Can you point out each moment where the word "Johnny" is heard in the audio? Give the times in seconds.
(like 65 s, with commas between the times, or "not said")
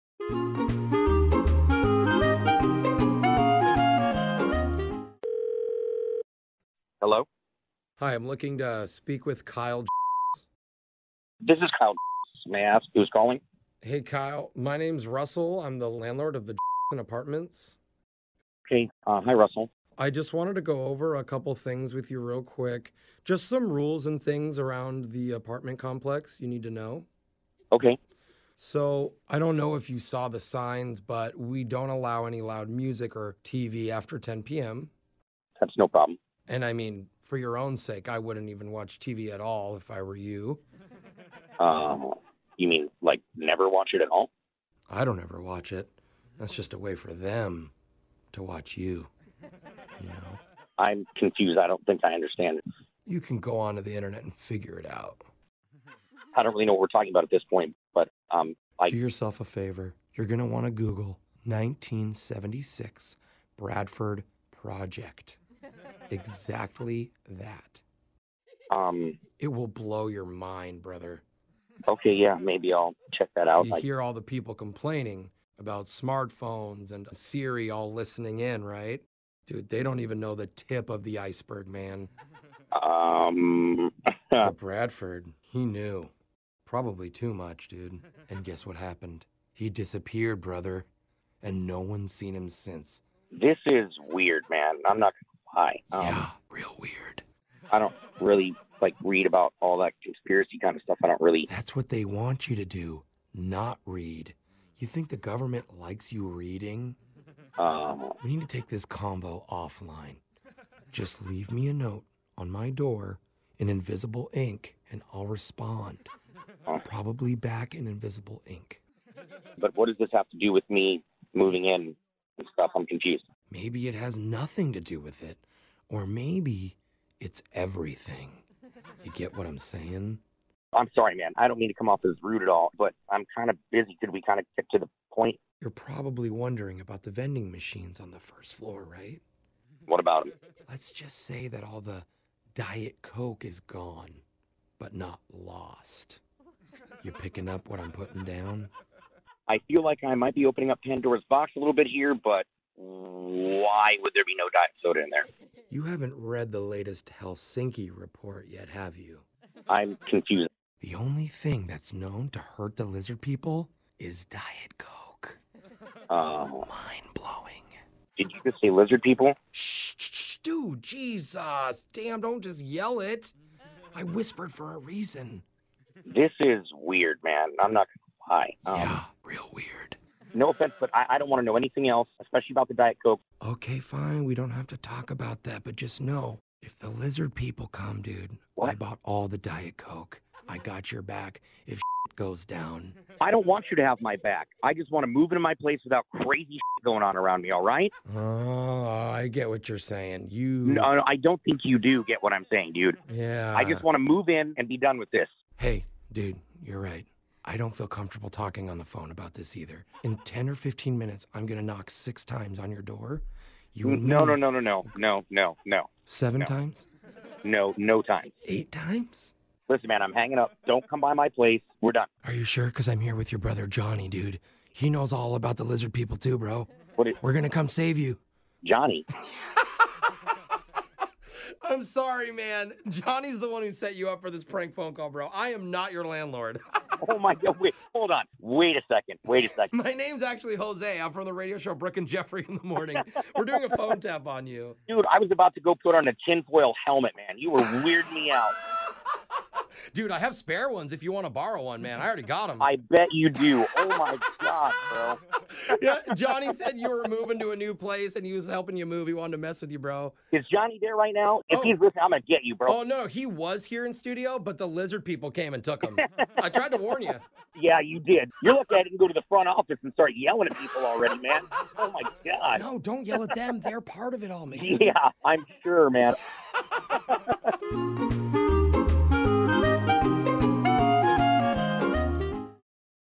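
223 s, 228 s, 232 s, 256 s, 260 s.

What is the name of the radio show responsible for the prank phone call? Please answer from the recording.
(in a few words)
Brooke and Jeffrey in the Morning.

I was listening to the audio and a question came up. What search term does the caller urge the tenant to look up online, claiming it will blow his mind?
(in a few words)
1976 Bradford Project.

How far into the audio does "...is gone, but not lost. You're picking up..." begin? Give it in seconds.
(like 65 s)
143 s.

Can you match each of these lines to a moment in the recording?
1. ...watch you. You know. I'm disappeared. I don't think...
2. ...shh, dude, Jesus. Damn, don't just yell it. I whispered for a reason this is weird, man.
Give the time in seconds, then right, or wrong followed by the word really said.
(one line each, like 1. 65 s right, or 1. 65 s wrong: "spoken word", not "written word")
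1. 48 s wrong: "confused", not "disappeared"
2. 169 s right.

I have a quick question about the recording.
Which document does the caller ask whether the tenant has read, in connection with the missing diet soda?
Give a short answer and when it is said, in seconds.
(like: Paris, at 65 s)
Helsinki report, at 157 s.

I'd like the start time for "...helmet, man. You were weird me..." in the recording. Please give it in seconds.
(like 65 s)
246 s.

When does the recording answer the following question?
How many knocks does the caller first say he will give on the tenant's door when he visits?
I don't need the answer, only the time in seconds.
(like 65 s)
211 s.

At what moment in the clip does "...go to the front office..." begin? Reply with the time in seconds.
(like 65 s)
268 s.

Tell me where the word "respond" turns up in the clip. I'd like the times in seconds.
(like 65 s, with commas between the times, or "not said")
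115 s.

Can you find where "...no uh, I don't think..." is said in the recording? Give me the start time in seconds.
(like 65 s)
200 s.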